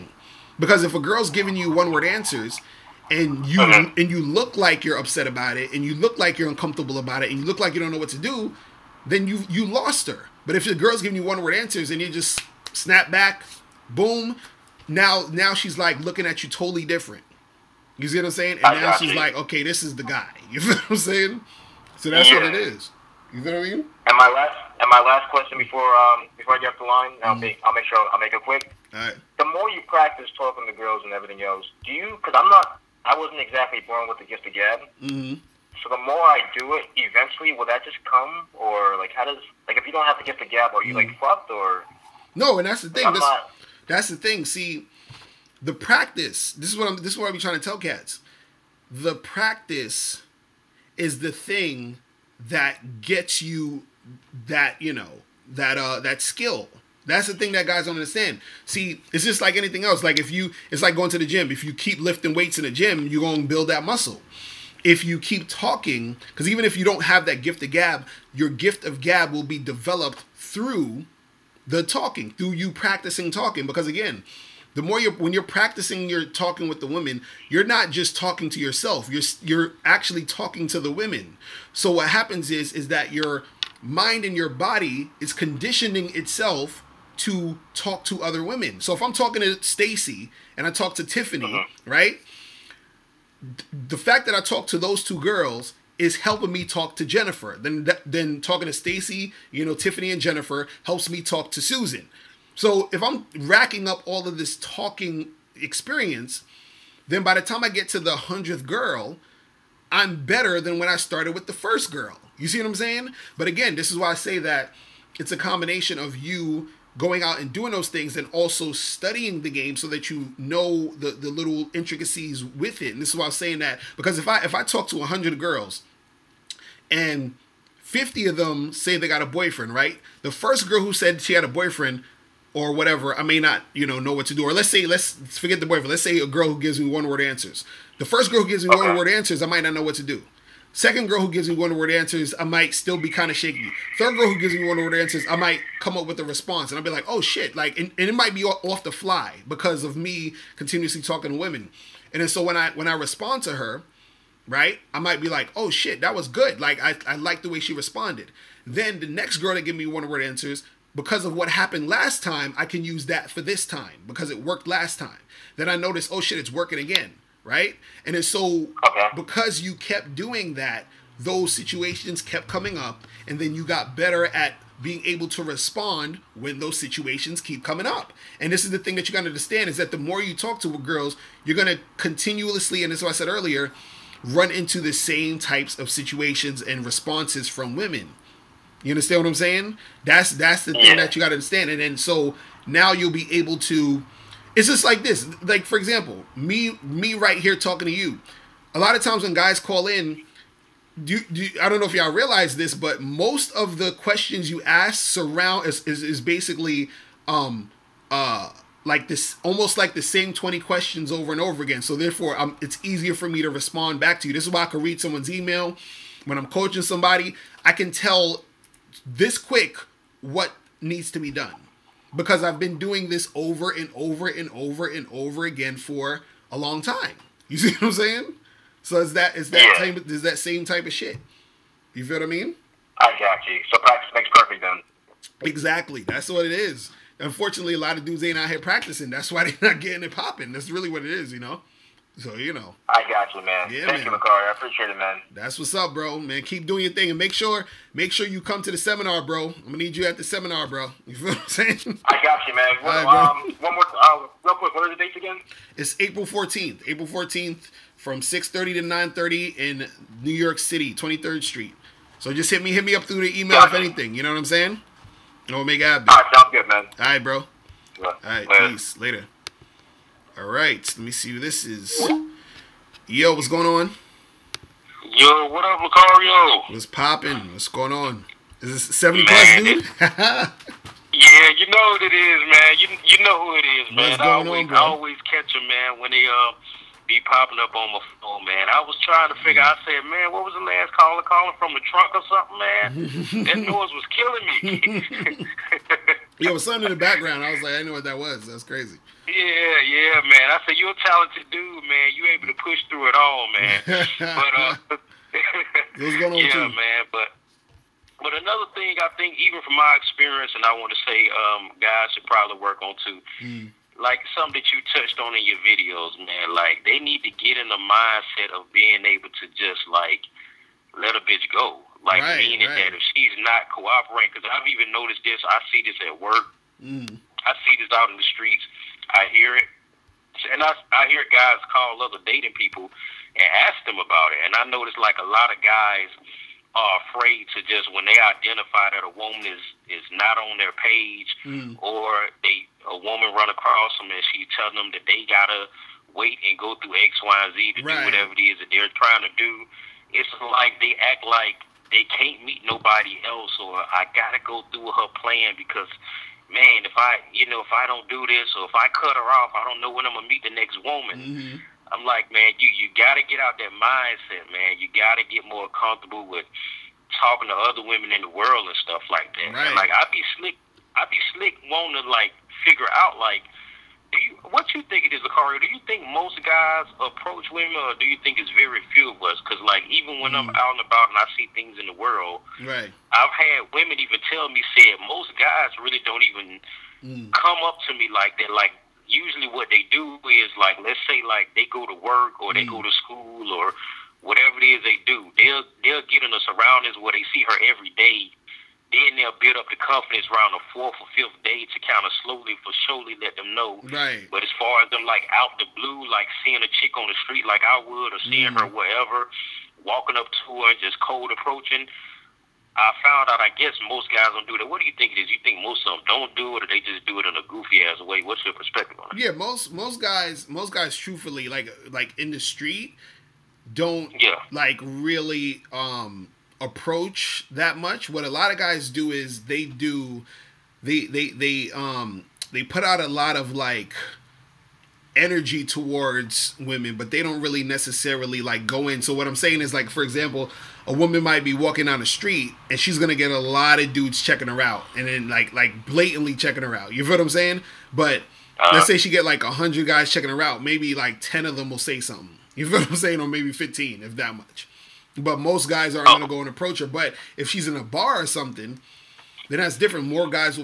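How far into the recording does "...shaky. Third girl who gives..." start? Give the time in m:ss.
2:23.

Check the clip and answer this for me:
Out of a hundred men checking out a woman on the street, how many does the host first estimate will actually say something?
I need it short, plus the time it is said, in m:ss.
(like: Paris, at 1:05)
10, at 7:31.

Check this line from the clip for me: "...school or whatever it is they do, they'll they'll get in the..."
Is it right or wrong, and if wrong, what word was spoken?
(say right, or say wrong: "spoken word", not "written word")
right.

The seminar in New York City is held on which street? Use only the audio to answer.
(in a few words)
23rd Street.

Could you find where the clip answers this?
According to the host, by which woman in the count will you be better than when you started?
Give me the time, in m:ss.
1:48.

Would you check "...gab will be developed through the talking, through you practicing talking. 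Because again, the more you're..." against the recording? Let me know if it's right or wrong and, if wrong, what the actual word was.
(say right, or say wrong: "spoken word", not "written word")
right.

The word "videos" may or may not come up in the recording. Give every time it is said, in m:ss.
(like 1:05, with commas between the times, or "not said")
5:15.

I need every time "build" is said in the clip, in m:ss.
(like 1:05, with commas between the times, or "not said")
1:03, 6:39.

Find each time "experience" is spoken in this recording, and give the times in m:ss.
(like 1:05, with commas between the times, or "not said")
1:45, 5:09.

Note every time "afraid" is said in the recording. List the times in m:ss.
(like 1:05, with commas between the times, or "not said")
5:37.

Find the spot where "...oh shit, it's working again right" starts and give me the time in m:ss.
2:46.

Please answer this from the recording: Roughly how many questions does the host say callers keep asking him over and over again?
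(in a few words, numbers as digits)
20.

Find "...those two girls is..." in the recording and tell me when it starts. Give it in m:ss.
1:34.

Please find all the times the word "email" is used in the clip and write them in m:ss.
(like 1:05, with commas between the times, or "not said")
3:35, 4:23.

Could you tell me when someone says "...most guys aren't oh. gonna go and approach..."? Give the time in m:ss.
7:35.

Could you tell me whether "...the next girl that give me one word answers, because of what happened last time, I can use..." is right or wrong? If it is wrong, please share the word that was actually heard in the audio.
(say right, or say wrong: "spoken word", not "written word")
right.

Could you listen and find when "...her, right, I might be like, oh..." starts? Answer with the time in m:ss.
2:33.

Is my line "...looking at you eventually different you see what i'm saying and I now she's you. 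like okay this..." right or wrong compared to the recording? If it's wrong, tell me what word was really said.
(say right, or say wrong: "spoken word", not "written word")
wrong: "totally", not "eventually".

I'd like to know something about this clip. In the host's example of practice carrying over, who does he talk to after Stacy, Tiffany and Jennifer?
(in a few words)
Susan.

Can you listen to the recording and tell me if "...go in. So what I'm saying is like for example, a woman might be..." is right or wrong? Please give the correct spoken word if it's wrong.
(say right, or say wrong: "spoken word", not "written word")
right.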